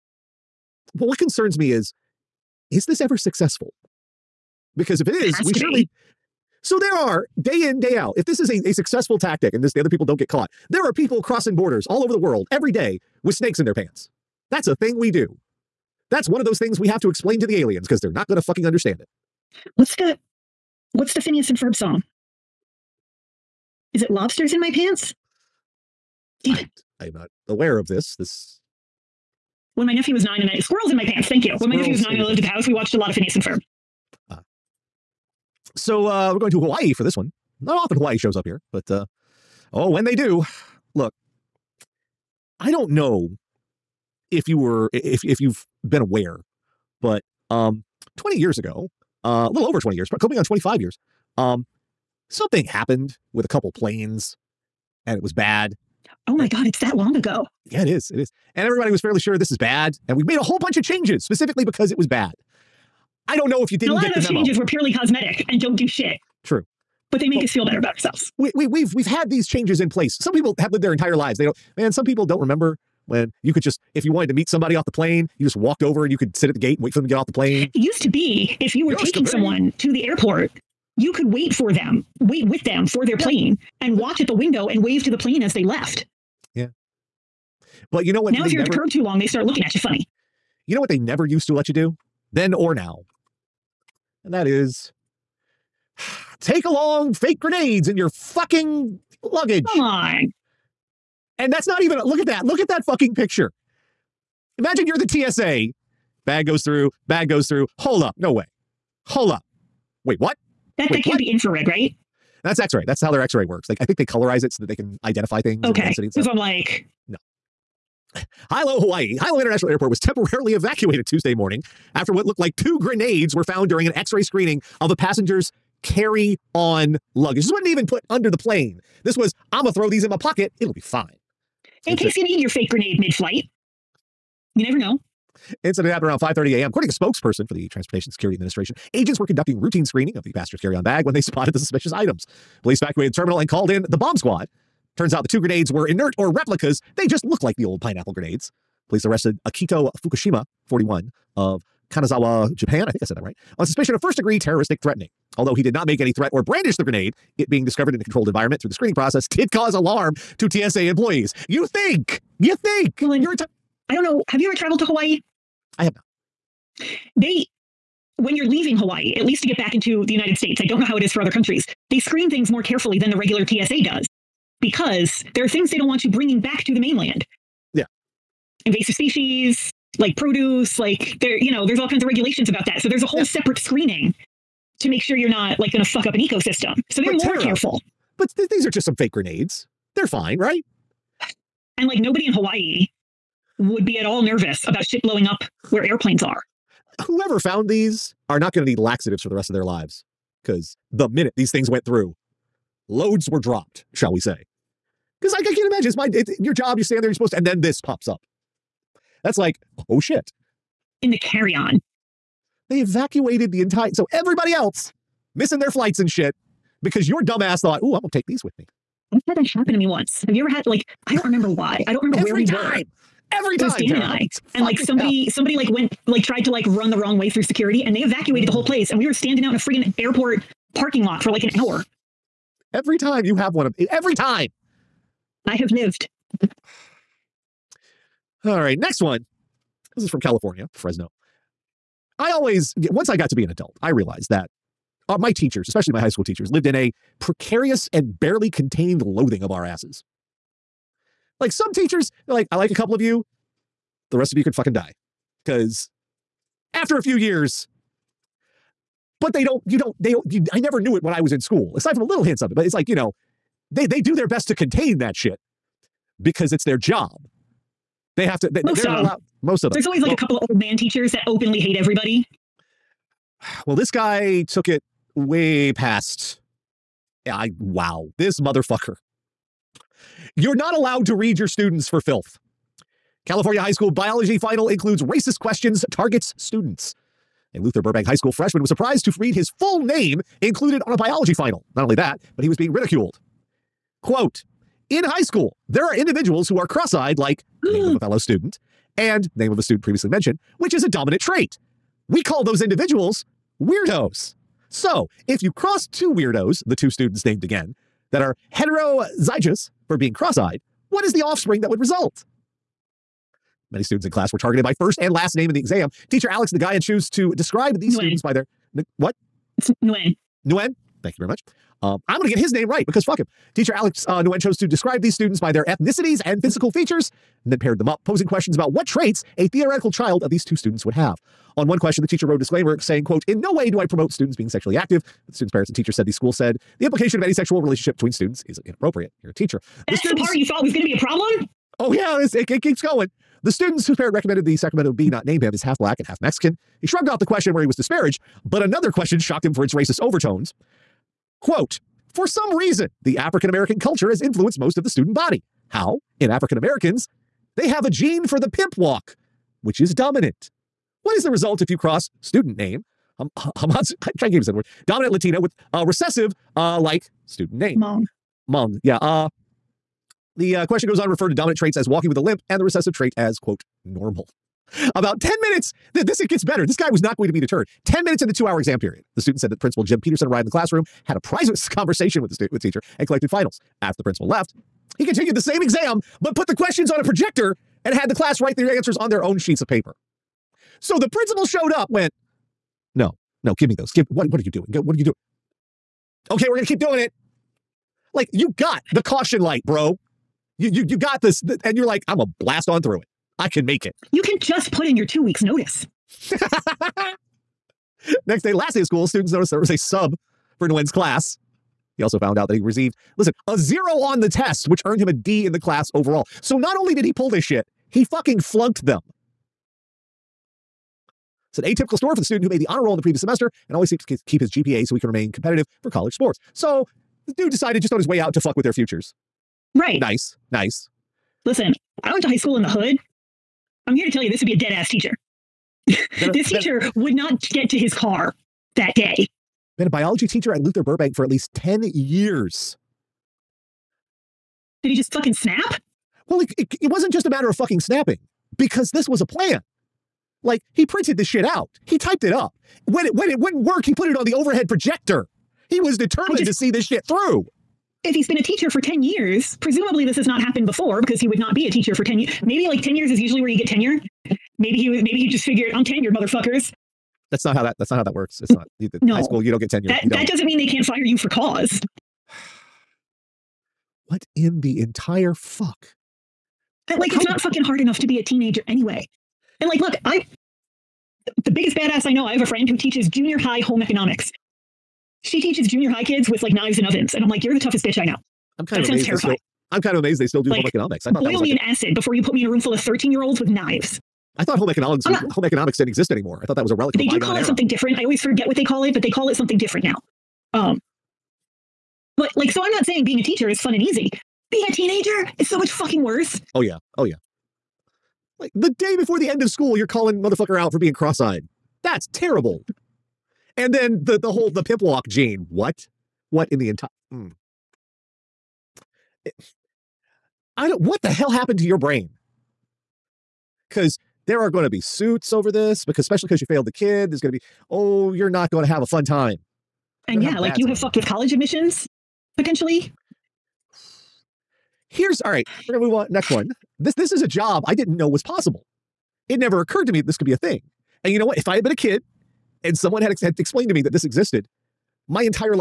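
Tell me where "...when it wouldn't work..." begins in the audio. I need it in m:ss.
7:33.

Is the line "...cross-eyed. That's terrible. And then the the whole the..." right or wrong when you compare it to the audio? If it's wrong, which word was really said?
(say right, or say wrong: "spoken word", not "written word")
right.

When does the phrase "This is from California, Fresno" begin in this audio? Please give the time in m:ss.
3:59.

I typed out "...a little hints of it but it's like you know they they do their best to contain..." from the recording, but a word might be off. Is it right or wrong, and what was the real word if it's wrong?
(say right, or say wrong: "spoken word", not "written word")
right.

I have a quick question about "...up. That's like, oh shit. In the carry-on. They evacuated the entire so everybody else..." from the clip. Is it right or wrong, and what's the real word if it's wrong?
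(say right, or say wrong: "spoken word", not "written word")
right.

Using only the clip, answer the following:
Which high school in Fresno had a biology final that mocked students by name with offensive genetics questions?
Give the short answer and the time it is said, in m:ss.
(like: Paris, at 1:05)
Luther Burbank High School, at 4:47.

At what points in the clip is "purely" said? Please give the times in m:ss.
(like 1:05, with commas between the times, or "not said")
1:04.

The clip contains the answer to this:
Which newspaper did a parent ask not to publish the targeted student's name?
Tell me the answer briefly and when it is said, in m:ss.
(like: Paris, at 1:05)
Sacramento Bee, at 5:44.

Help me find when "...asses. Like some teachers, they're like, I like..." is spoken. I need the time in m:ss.
4:09.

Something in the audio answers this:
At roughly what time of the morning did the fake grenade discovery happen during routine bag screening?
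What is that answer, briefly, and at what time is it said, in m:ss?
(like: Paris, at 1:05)
5:30 a.m., at 2:16.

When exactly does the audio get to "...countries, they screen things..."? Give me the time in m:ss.
2:51.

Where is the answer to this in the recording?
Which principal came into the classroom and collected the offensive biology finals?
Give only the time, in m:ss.
6:19.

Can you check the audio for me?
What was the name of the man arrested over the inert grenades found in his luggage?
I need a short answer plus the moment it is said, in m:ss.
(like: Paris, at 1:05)
Akito Fukushima, at 2:29.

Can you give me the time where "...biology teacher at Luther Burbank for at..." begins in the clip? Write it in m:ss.
7:19.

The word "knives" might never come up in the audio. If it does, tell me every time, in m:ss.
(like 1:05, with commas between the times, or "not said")
8:06, 8:13.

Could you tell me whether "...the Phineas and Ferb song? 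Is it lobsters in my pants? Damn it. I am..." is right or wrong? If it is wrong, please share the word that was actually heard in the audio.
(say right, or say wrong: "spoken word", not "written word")
right.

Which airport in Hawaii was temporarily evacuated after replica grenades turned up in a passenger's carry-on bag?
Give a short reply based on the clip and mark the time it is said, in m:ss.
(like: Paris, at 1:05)
Hilo International Airport, at 1:59.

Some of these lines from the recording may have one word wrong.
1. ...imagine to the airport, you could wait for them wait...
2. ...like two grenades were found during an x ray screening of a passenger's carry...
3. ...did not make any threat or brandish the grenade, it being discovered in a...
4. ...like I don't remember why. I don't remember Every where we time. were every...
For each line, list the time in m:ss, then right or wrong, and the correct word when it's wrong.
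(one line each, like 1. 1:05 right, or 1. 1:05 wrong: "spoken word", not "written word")
1. 1:19 wrong: "someone", not "imagine"
2. 2:02 right
3. 2:35 right
4. 3:40 right.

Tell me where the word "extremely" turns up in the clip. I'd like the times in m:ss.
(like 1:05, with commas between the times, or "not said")
not said.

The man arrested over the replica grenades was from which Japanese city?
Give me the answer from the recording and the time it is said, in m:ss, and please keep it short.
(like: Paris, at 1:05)
Kanazawa, at 2:31.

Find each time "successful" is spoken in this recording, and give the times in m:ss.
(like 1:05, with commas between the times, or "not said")
0:03, 0:08.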